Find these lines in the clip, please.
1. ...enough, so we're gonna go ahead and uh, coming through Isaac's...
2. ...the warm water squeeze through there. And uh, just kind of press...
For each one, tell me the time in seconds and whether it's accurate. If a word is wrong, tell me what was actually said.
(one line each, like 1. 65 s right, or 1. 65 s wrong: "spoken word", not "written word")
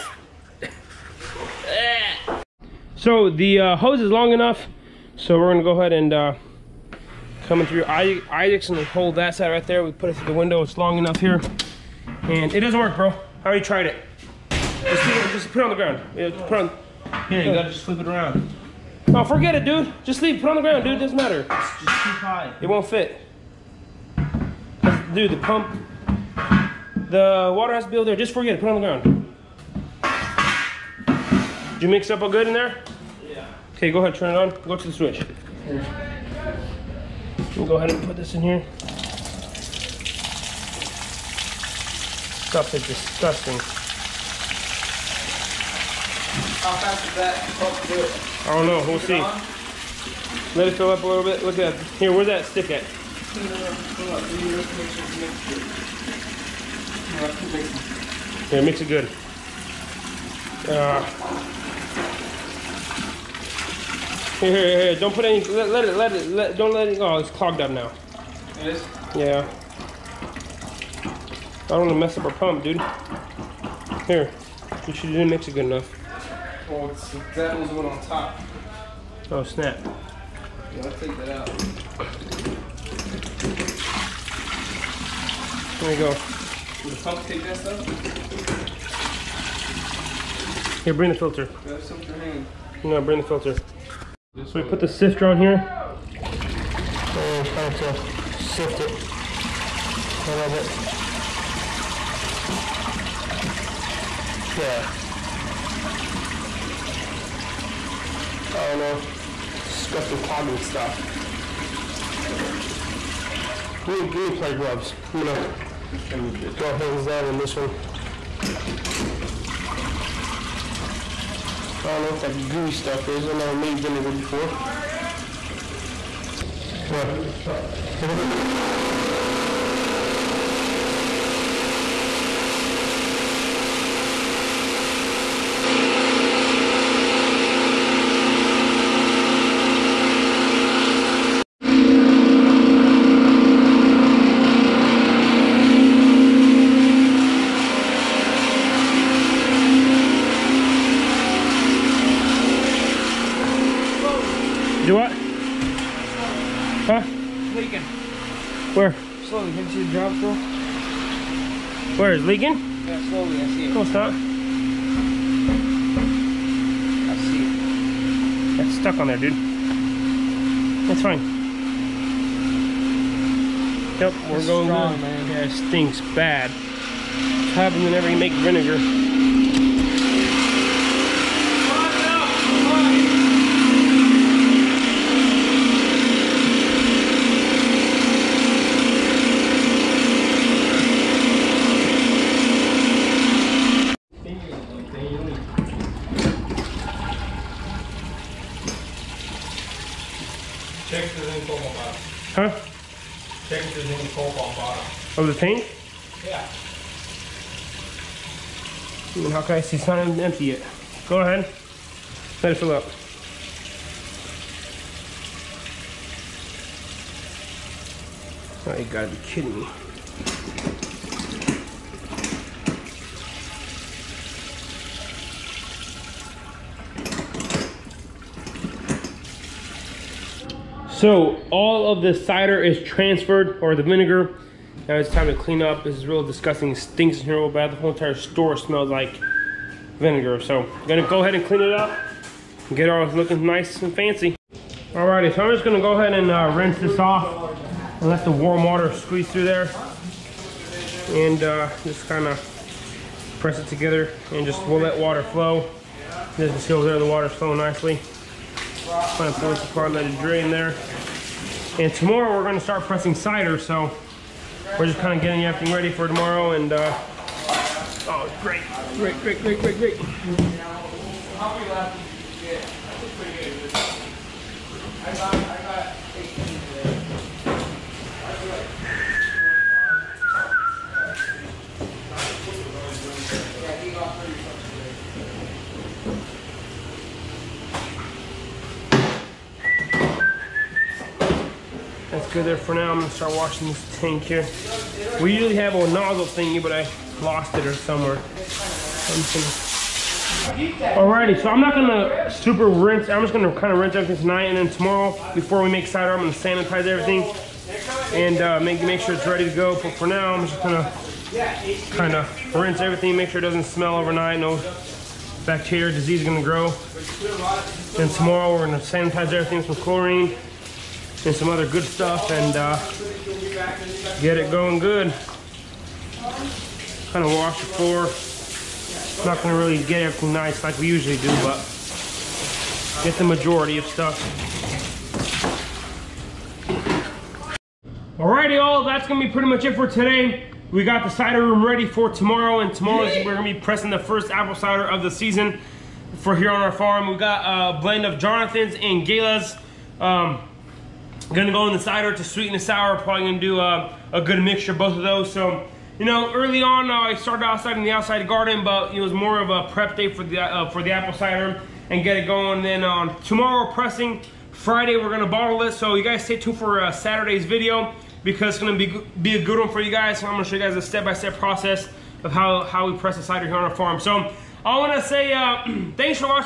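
1. 4 s right
2. 248 s right.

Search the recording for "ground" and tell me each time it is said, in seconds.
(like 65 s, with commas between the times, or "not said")
15 s, 20 s, 28 s.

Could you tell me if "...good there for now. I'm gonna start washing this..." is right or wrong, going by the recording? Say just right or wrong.
right.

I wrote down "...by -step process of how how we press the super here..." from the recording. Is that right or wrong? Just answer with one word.
wrong.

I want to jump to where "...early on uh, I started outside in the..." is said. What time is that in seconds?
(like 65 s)
356 s.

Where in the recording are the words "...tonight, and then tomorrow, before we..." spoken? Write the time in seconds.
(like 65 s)
304 s.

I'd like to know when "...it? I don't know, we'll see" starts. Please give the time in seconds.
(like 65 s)
48 s.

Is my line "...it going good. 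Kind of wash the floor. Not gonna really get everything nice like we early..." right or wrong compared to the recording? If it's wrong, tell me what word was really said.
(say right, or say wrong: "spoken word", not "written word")
wrong: "usually", not "early".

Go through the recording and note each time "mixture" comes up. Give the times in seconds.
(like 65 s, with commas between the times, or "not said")
354 s.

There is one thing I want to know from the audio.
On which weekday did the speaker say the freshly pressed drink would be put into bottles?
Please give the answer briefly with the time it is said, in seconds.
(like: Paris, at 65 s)
Friday, at 364 s.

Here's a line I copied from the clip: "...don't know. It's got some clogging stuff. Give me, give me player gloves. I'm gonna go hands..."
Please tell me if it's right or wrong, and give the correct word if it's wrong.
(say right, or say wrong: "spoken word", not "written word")
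right.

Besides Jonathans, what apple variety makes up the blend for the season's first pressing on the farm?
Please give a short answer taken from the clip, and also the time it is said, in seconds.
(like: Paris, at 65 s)
Gala, at 349 s.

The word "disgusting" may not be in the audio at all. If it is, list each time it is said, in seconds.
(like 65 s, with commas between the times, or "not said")
42 s, 236 s.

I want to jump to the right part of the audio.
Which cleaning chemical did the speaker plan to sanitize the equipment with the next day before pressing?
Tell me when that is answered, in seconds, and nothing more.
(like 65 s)
319 s.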